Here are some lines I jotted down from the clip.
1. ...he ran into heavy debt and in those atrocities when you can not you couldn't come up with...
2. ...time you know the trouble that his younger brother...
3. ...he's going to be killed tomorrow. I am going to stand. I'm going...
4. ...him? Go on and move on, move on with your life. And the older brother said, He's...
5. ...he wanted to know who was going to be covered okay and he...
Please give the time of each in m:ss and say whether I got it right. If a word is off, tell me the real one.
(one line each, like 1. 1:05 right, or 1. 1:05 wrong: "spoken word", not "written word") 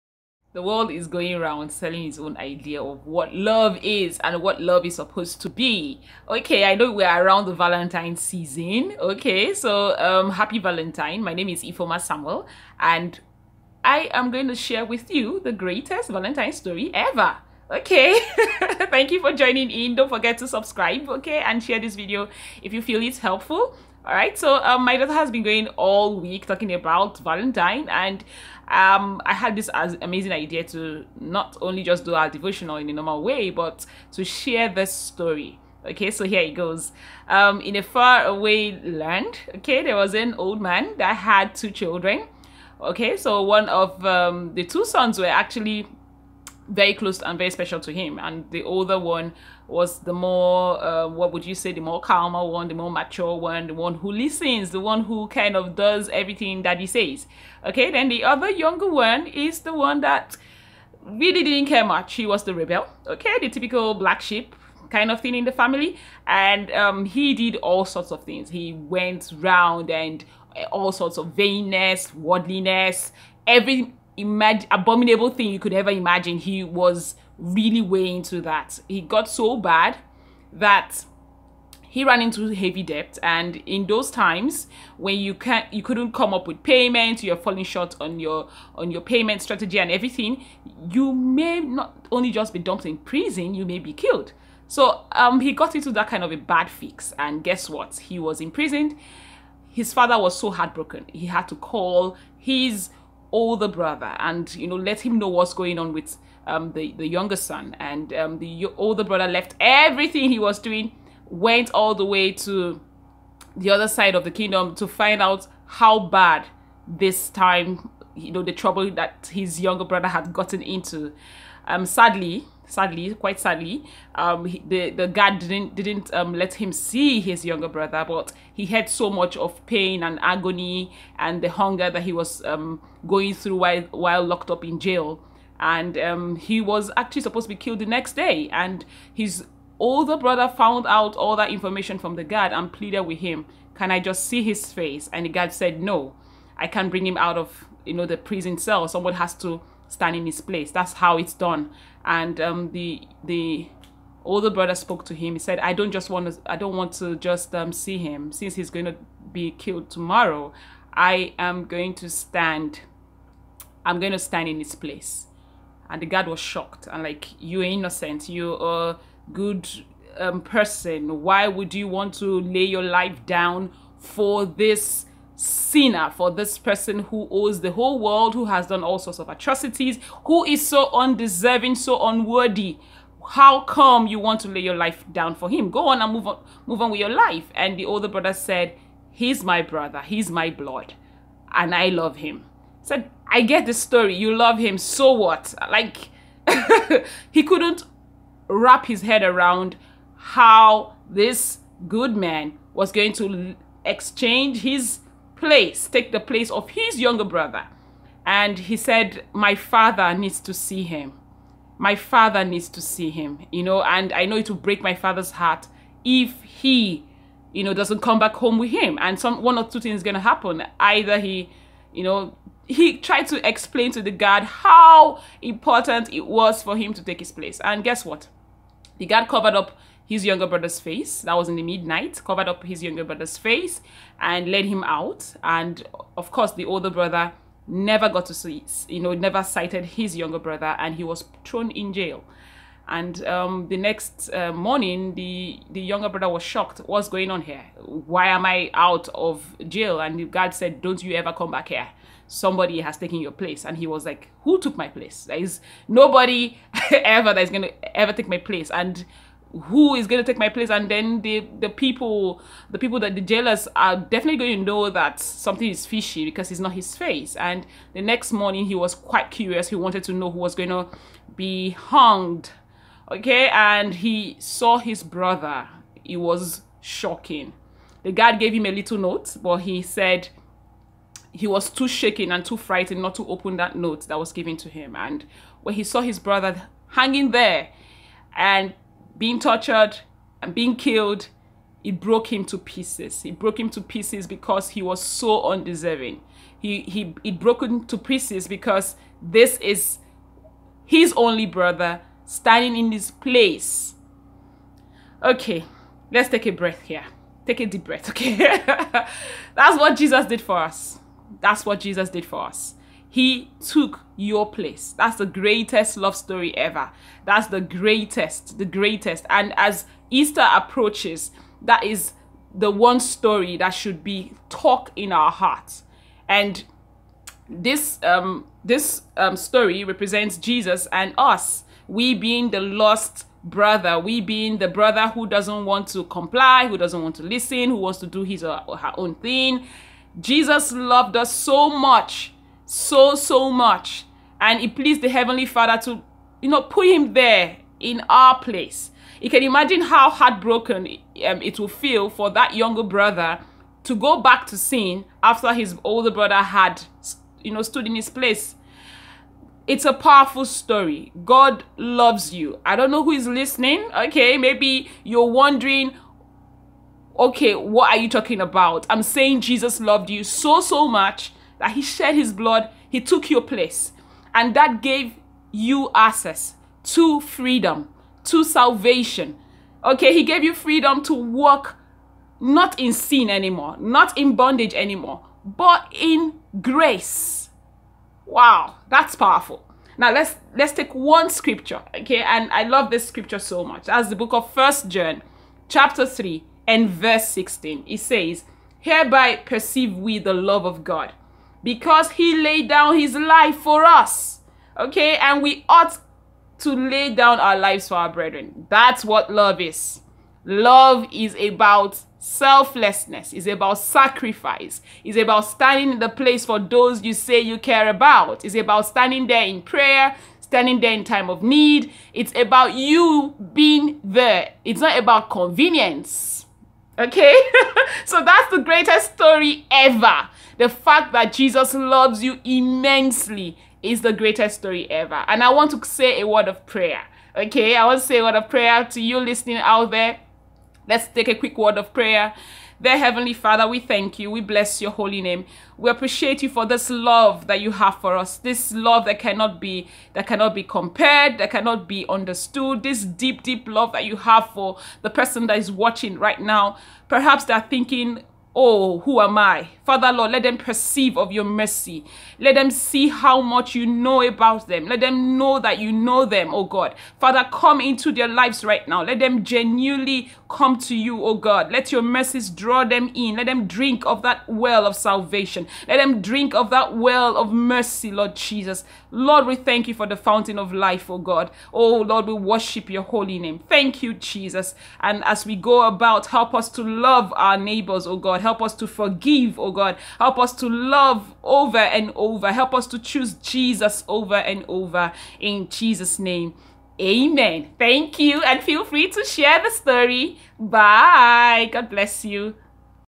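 1. 1:21 wrong: "times", not "atrocities"
2. 1:57 right
3. 2:38 right
4. 3:05 right
5. 4:29 wrong: "hanged", not "covered".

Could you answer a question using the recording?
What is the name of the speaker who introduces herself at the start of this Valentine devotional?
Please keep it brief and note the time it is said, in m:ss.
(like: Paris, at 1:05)
Ifeoma Samuel, at 0:11.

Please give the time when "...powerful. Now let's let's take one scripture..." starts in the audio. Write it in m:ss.
6:29.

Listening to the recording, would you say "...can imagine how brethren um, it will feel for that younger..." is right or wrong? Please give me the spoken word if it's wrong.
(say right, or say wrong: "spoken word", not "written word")
wrong: "heartbroken", not "brethren".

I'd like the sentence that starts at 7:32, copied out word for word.
This deep, deep love that you have for the person that is watching right now.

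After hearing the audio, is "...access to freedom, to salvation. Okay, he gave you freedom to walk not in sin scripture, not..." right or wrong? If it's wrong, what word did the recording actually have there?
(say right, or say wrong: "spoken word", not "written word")
wrong: "anymore", not "scripture".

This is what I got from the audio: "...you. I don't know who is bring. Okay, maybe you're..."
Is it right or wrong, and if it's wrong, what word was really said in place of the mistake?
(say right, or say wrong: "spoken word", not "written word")
wrong: "listening", not "bring".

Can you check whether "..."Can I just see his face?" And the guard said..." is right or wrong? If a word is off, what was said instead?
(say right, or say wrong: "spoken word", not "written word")
right.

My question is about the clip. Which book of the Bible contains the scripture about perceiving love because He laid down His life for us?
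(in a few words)
First John.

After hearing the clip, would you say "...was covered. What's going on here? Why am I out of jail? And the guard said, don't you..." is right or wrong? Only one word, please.
wrong.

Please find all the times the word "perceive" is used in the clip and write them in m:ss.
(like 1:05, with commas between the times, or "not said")
6:39, 7:40.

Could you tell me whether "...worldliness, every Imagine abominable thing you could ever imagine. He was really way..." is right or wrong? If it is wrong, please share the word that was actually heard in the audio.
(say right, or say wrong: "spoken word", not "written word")
right.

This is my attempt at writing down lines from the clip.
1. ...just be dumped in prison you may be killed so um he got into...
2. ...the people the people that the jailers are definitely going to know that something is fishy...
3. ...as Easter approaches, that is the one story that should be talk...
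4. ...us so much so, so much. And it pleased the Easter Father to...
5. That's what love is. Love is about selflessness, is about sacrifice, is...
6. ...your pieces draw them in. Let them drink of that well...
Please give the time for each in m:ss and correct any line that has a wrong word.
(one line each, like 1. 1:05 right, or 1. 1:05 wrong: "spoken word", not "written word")
1. 1:32 right
2. 4:21 right
3. 5:19 right
4. 5:41 wrong: "Heavenly", not "Easter"
5. 6:48 right
6. 7:51 wrong: "mercies", not "pieces".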